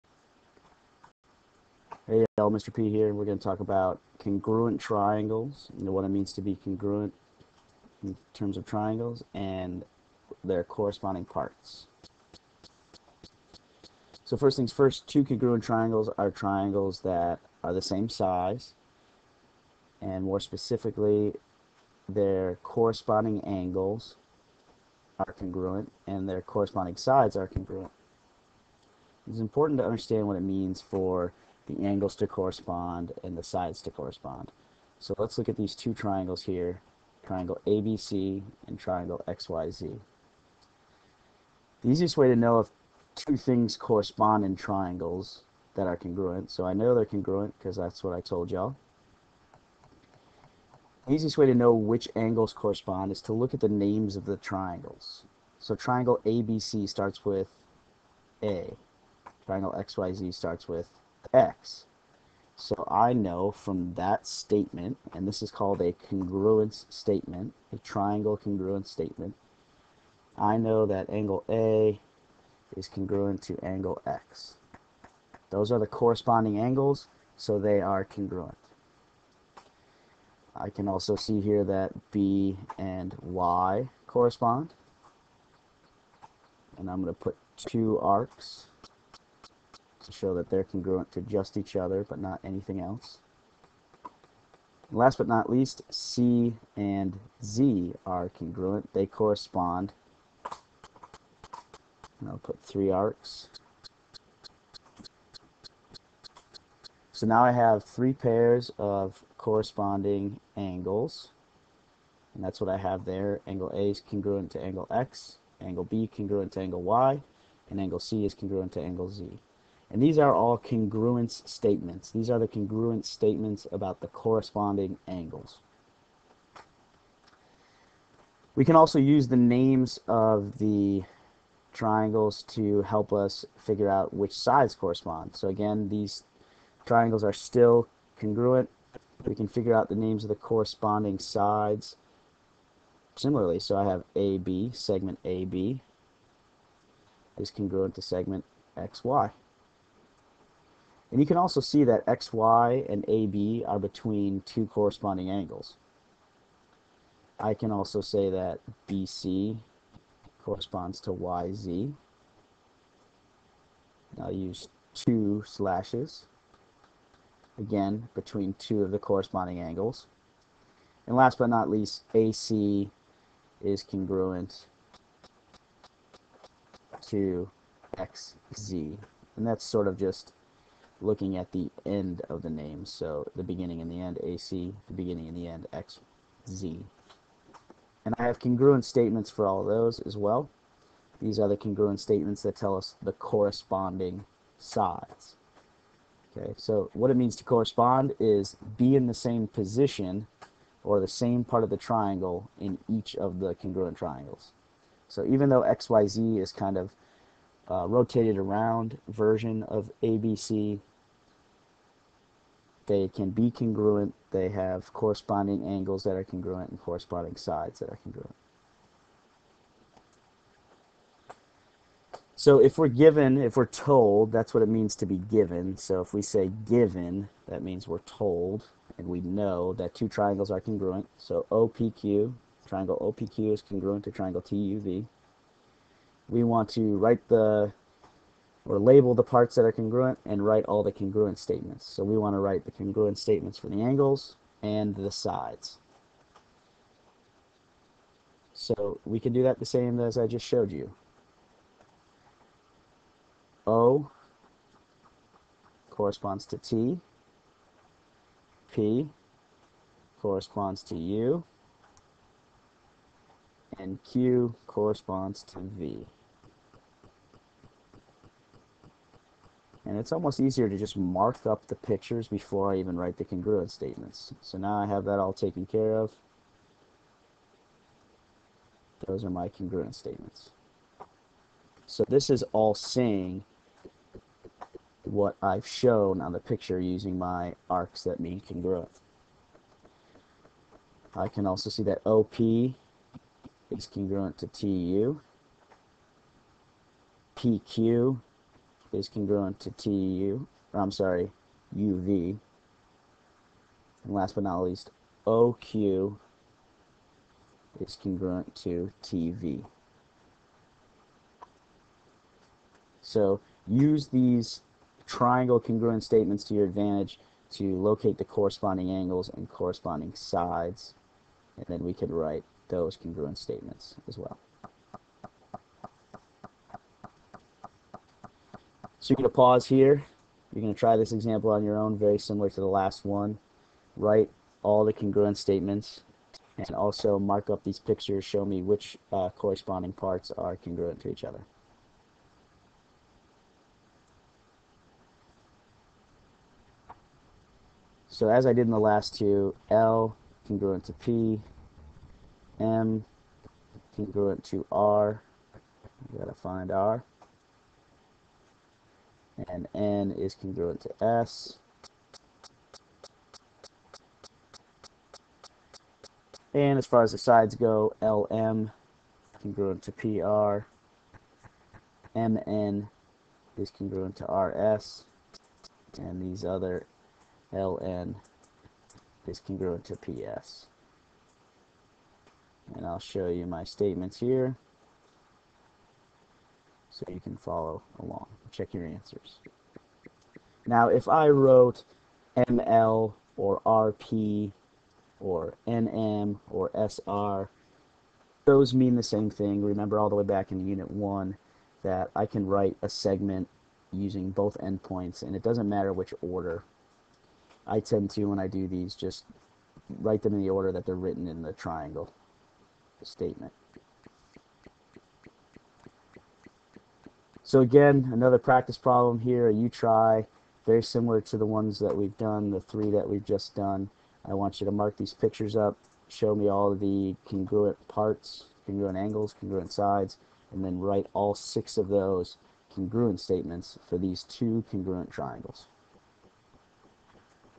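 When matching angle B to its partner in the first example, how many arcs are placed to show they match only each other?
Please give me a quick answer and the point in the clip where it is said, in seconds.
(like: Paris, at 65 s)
2, at 87 s.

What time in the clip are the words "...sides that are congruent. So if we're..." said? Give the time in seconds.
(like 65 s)
217 s.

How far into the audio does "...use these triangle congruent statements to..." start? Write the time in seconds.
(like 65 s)
313 s.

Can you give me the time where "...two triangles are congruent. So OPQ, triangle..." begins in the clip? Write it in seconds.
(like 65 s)
229 s.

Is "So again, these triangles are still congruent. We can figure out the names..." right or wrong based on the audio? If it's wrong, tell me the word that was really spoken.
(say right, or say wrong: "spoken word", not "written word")
right.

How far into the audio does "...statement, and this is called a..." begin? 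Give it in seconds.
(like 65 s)
64 s.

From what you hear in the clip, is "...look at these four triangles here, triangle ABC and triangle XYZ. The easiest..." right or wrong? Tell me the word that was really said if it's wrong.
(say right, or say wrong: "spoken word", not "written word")
wrong: "two", not "four".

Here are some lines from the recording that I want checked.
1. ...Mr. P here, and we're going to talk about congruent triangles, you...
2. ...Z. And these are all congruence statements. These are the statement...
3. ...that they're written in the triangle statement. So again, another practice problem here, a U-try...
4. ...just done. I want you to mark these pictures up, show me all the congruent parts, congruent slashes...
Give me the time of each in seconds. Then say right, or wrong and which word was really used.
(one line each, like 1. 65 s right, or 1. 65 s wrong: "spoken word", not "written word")
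1. 2 s right
2. 119 s wrong: "congruent", not "statement"
3. 410 s right
4. 423 s wrong: "angles", not "slashes".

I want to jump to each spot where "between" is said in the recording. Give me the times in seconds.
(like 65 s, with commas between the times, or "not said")
153 s, 168 s.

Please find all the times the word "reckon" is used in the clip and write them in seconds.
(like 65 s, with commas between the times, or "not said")
not said.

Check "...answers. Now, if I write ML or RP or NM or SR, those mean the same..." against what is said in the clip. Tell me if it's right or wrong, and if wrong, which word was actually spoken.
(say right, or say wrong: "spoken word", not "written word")
wrong: "wrote", not "write".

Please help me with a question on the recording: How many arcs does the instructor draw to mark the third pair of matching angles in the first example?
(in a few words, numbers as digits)
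3.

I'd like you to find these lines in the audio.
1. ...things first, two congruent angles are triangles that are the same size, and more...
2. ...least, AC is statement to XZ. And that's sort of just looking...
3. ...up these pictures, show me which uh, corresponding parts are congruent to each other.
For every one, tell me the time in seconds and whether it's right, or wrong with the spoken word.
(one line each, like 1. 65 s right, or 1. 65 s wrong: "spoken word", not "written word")
1. 14 s wrong: "triangles", not "angles"
2. 171 s wrong: "congruent", not "statement"
3. 337 s right.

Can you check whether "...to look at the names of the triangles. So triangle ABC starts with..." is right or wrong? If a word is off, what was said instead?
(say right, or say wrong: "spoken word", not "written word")
right.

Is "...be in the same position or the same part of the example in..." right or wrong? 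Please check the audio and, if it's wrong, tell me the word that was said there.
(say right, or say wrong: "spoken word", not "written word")
wrong: "triangle", not "example".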